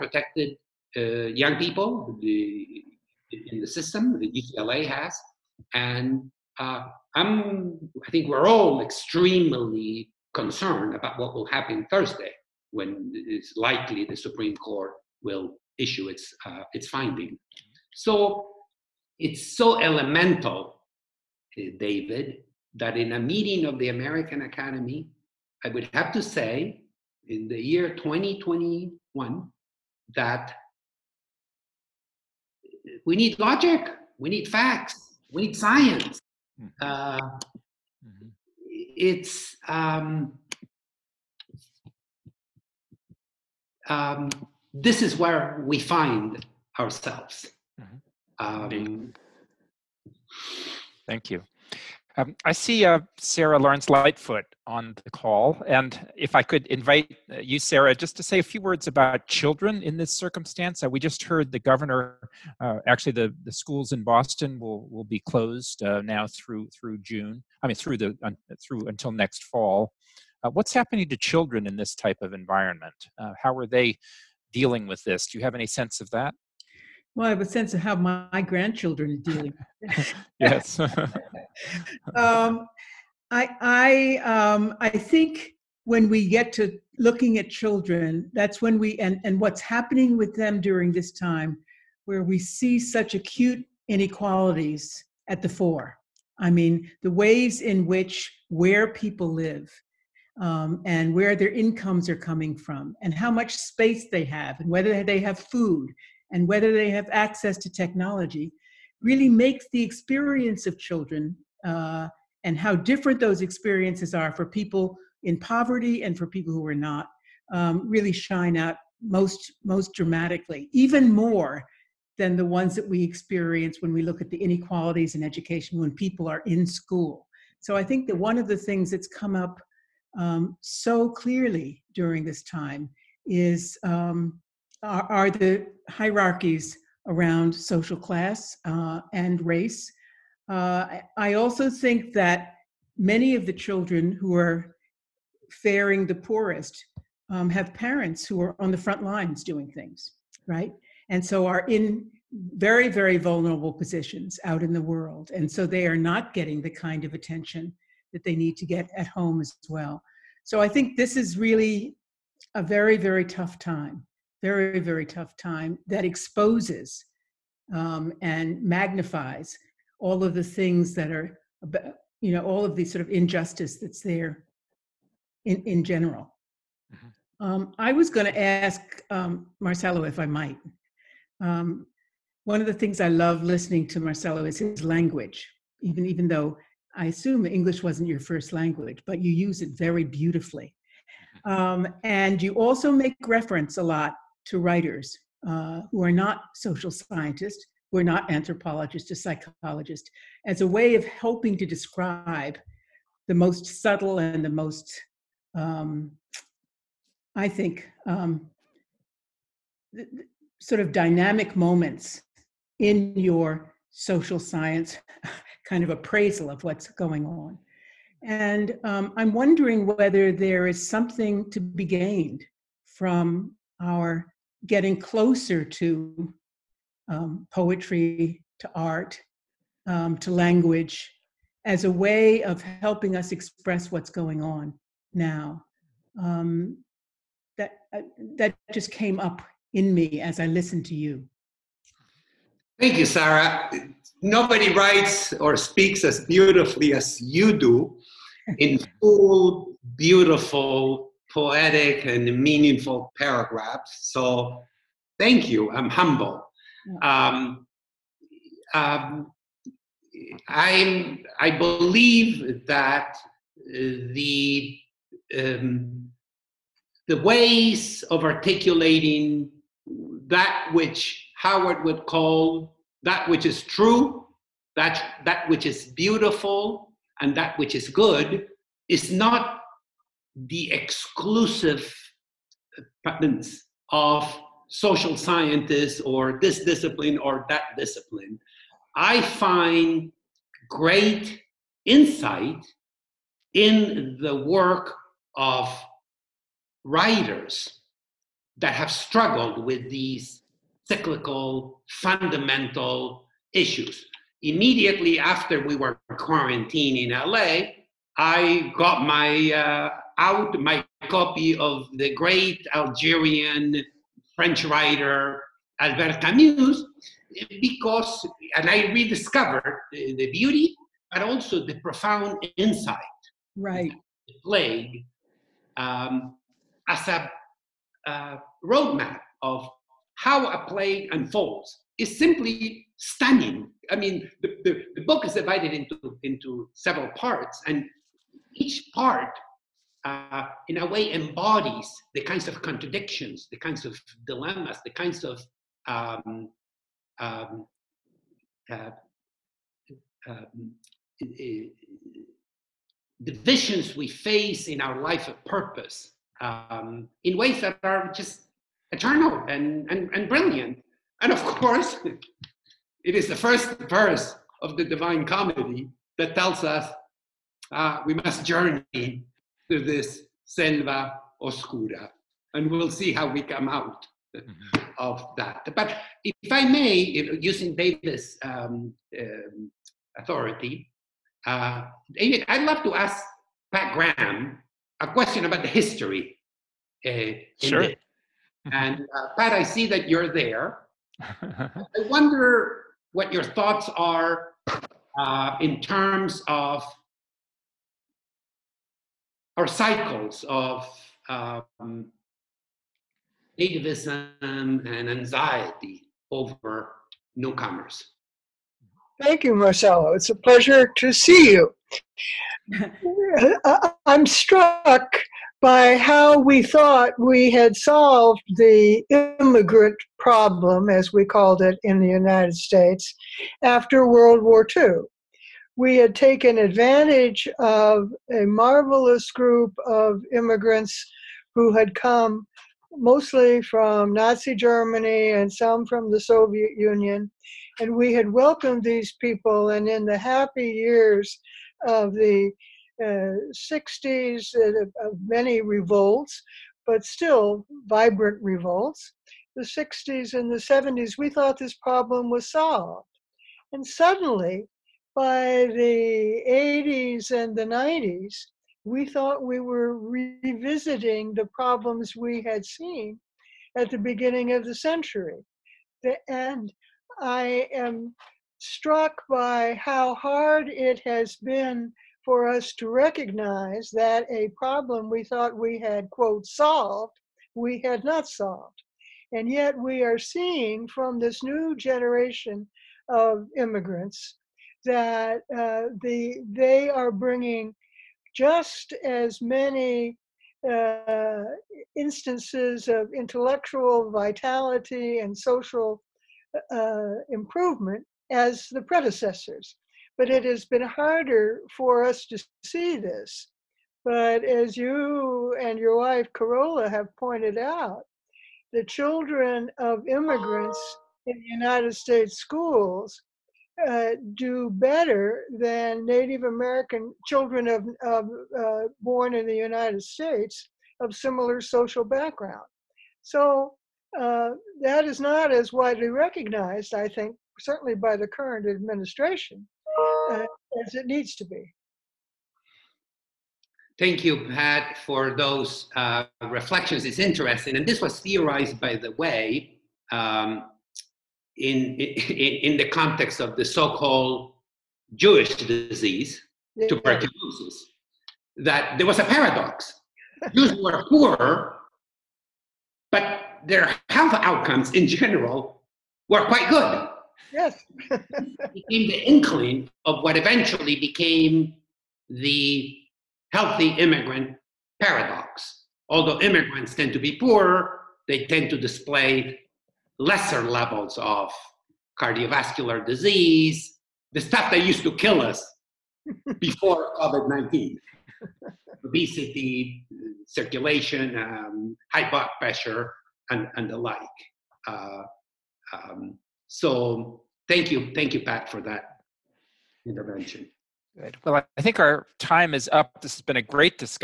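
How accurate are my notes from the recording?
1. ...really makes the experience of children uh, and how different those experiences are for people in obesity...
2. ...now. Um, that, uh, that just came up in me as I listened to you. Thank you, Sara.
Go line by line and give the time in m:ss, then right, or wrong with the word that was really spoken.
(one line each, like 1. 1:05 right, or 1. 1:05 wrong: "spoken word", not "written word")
1. 1:49 wrong: "poverty", not "obesity"
2. 3:55 right.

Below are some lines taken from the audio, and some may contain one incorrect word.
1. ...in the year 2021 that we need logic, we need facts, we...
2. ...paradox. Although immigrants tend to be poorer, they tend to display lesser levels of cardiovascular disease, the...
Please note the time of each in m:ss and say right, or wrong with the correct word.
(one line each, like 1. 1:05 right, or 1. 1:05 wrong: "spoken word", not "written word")
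1. 0:27 right
2. 9:25 right.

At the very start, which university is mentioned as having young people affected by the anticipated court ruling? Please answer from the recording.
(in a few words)
UCLA.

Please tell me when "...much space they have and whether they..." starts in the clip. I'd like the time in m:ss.
1:43.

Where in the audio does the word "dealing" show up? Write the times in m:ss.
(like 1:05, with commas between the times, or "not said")
1:14, 1:19.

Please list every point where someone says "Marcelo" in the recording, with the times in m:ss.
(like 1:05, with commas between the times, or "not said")
2:59, 3:04, 6:49.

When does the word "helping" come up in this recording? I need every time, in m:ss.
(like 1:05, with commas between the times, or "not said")
3:21, 3:52.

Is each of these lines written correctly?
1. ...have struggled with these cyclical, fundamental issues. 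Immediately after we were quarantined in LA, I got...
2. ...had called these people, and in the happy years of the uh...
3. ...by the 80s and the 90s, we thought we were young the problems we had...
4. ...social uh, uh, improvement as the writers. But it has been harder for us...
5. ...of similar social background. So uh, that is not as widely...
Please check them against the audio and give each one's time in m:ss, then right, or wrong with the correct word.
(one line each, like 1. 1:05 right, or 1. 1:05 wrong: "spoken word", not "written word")
1. 4:58 right
2. 7:18 wrong: "welcomed", not "called"
3. 7:35 wrong: "revisiting", not "young"
4. 8:15 wrong: "predecessors", not "writers"
5. 8:41 right.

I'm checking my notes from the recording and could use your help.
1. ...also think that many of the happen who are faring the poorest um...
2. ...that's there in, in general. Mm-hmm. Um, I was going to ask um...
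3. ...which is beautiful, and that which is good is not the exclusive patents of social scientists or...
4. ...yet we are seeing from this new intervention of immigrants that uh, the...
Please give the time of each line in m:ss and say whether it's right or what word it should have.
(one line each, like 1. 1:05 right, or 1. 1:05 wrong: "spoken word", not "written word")
1. 2:21 wrong: "children", not "happen"
2. 2:53 right
3. 4:35 right
4. 7:59 wrong: "generation", not "intervention".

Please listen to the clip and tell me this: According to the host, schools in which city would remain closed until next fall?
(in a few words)
Boston.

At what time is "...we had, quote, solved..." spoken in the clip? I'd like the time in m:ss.
7:55.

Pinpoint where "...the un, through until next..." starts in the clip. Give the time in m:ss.
1:07.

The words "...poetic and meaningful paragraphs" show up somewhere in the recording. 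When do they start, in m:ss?
4:11.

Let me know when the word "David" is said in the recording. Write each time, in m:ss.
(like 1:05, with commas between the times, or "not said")
0:21, 6:17, 6:22.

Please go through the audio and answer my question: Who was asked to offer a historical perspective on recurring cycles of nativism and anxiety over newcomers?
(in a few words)
Pat Graham.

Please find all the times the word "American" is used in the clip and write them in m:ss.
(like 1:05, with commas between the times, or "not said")
0:23, 8:36.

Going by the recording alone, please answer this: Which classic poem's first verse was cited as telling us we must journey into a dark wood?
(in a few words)
The Divine Comedy.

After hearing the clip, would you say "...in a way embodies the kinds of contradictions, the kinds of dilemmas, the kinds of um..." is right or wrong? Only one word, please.
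right.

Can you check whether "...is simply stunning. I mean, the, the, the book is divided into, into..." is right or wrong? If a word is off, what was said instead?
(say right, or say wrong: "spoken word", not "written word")
right.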